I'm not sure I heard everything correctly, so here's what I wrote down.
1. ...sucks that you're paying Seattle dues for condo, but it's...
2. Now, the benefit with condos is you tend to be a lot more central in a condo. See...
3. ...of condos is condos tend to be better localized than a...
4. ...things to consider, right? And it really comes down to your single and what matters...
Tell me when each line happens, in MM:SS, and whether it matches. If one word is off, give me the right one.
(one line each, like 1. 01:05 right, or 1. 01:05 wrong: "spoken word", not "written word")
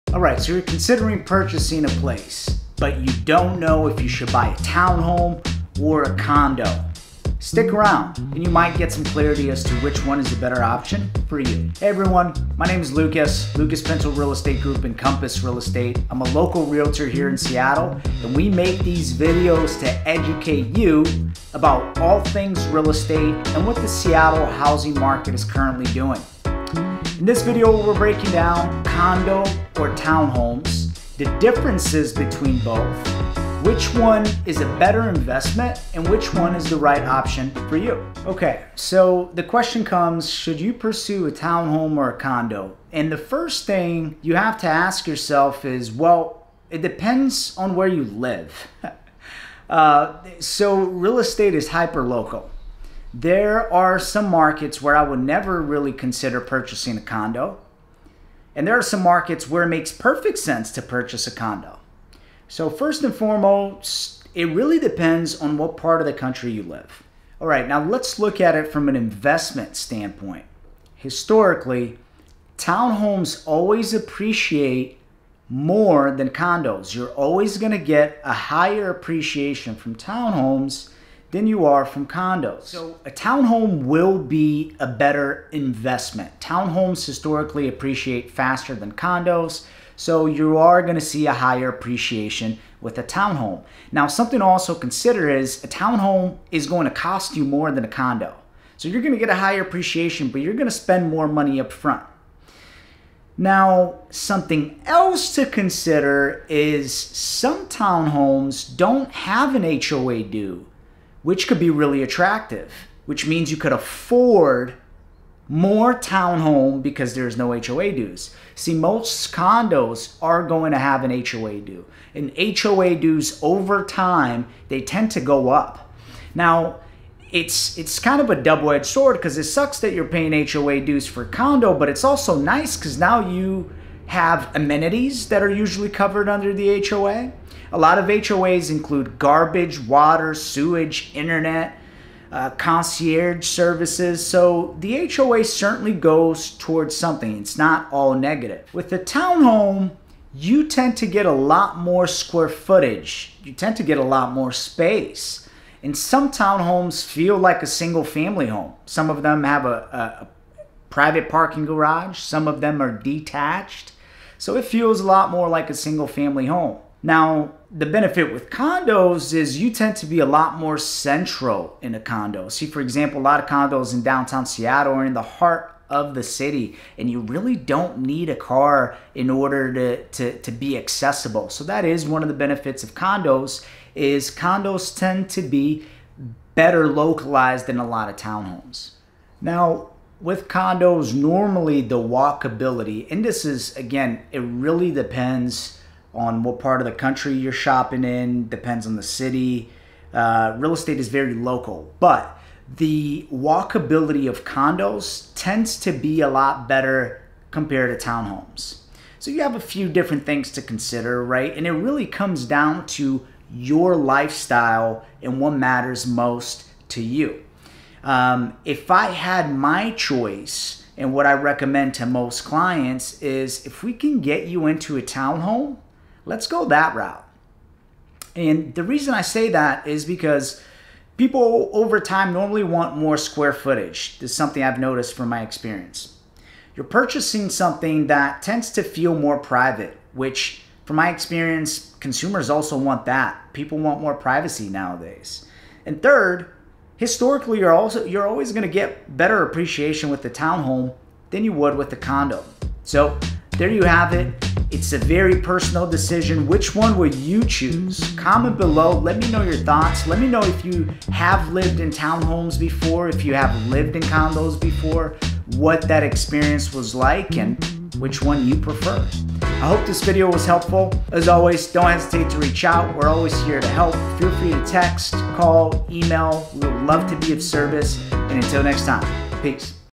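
1. 02:09 wrong: "HOA", not "Seattle"
2. 02:47 right
3. 03:02 right
4. 03:30 wrong: "lifestyle", not "single".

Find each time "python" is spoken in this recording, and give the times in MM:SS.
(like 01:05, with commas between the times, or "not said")
not said.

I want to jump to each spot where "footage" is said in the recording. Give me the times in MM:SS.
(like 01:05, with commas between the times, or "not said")
02:32, 03:53.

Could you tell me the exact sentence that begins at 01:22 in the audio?
So a townhome will be a better investment.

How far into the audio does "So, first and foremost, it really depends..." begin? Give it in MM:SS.
01:02.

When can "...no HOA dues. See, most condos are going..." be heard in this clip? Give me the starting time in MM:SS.
01:57.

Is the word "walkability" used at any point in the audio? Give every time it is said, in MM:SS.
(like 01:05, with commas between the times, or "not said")
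03:11, 03:23.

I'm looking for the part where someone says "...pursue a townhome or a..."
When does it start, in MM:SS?
00:40.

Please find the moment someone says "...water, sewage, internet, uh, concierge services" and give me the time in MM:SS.
02:19.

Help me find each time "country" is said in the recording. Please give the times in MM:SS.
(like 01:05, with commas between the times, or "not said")
01:06, 03:16.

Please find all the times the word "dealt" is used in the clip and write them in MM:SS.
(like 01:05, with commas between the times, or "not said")
not said.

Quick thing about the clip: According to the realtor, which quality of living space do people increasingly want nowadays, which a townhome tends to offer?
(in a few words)
privacy.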